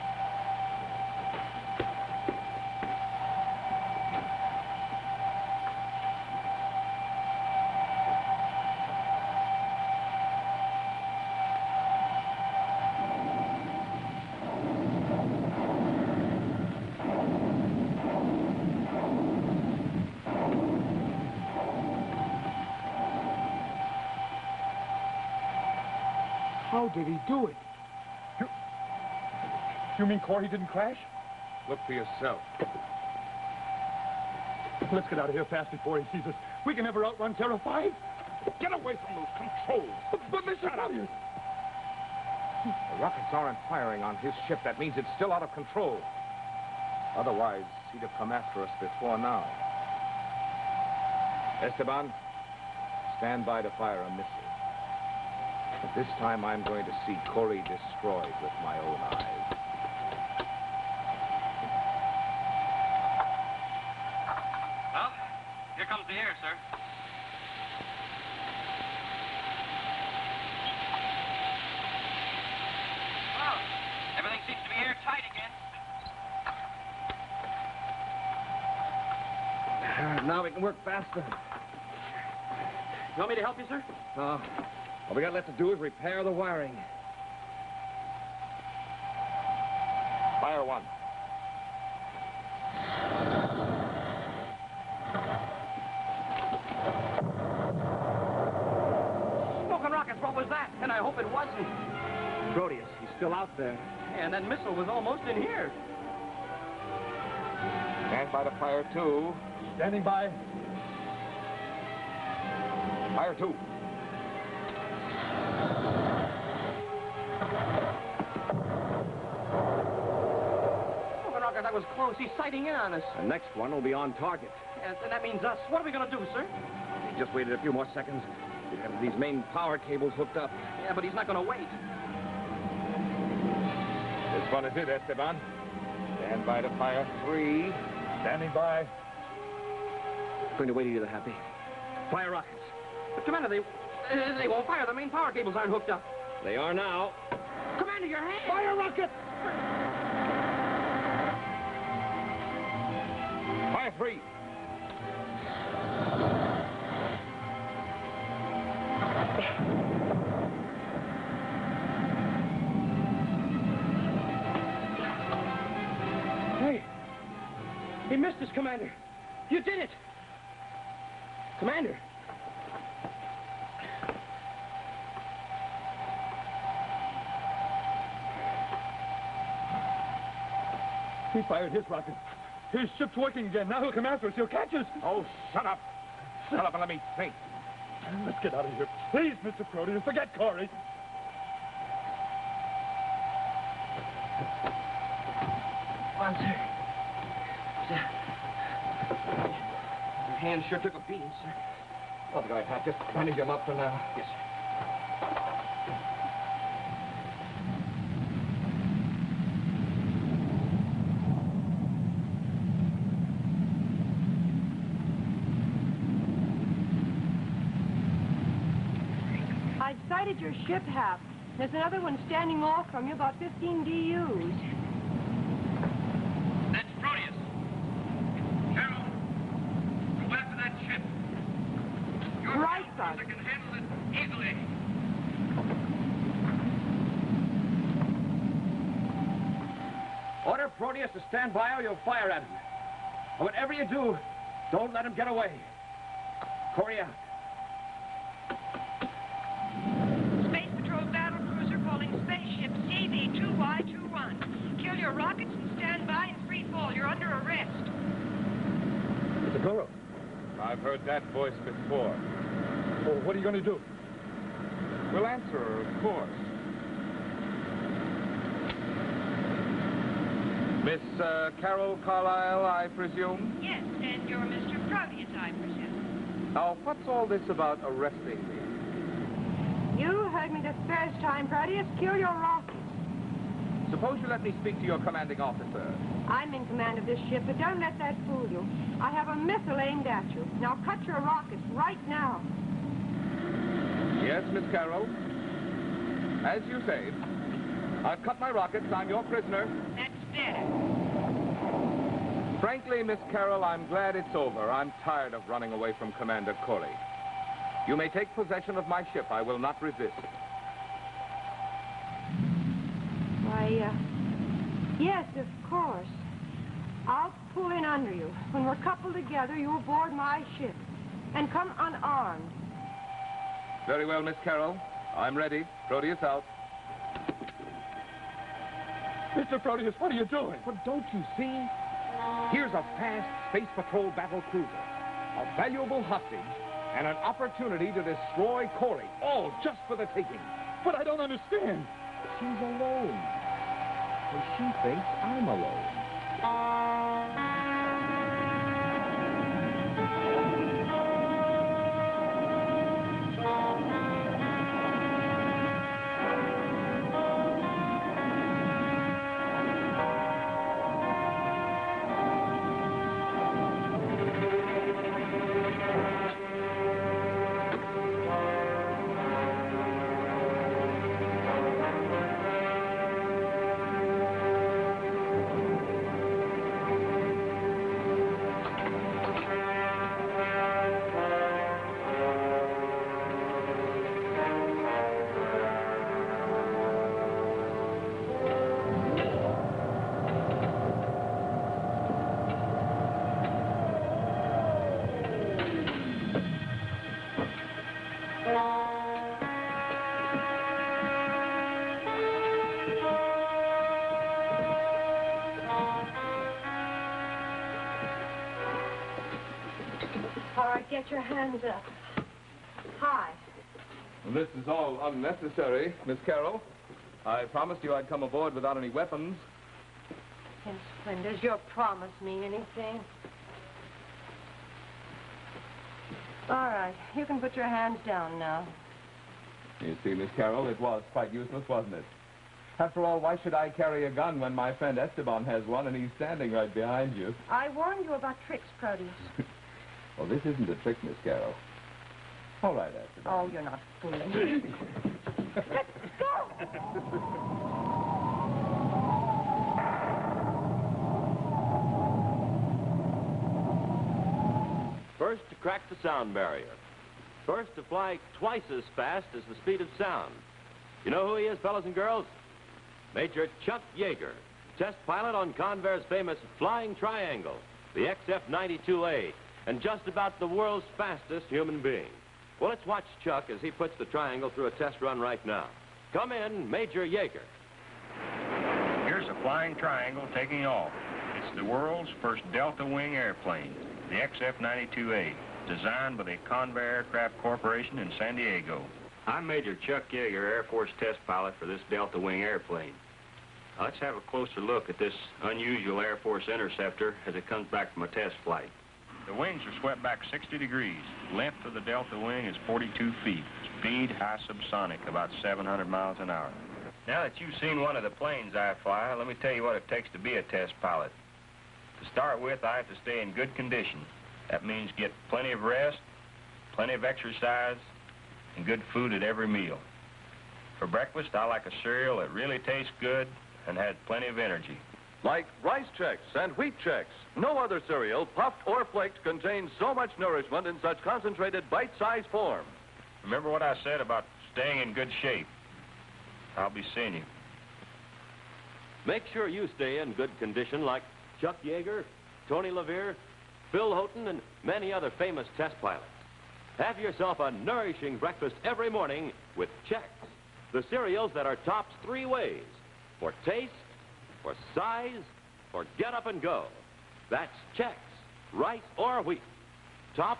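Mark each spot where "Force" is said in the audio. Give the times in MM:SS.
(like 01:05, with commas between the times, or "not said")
08:10, 08:16.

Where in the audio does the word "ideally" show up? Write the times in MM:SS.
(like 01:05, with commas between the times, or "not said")
not said.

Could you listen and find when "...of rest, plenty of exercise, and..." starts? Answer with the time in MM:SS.
08:35.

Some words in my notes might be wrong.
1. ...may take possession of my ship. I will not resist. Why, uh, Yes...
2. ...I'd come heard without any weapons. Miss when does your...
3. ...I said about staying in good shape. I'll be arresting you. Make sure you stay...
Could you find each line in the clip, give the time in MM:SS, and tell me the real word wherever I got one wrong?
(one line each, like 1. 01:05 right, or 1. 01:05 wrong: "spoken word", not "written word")
1. 05:07 right
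2. 06:57 wrong: "aboard", not "heard"
3. 08:53 wrong: "seeing", not "arresting".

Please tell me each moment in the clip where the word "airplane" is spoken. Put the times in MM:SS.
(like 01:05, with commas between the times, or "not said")
08:03, 08:12.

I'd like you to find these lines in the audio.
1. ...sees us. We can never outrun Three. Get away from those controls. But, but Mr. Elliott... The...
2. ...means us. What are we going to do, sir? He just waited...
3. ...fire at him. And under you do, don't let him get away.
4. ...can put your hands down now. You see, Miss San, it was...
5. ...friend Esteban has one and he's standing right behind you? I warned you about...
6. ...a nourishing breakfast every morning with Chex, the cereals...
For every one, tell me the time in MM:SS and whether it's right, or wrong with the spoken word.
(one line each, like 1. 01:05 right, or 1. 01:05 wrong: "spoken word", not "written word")
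1. 00:36 wrong: "Five", not "Three"
2. 02:05 right
3. 04:02 wrong: "whatever", not "under"
4. 07:07 wrong: "Carol", not "San"
5. 07:14 right
6. 09:07 right.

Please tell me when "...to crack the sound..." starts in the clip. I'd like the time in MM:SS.
07:35.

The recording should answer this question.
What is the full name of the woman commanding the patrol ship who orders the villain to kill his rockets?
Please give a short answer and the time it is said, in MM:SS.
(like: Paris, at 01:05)
Carol Carlisle, at 04:31.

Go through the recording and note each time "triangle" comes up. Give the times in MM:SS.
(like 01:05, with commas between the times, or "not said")
07:46, 07:54, 07:59.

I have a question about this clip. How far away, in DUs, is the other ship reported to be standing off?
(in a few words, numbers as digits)
15.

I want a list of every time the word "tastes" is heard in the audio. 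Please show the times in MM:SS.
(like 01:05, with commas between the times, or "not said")
08:42, 09:13.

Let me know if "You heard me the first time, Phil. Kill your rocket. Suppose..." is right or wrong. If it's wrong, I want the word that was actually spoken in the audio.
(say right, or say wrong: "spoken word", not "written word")
wrong: "Proteus", not "Phil".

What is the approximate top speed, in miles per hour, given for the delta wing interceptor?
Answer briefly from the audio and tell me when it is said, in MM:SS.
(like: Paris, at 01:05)
700, at 08:25.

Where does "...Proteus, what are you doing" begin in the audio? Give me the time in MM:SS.
05:29.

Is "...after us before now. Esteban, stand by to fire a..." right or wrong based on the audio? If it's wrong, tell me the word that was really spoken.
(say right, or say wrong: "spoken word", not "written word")
right.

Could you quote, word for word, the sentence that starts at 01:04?
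Well, here comes the air, sir.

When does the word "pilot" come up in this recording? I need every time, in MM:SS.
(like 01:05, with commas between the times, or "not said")
07:45, 08:11, 08:30, 09:05.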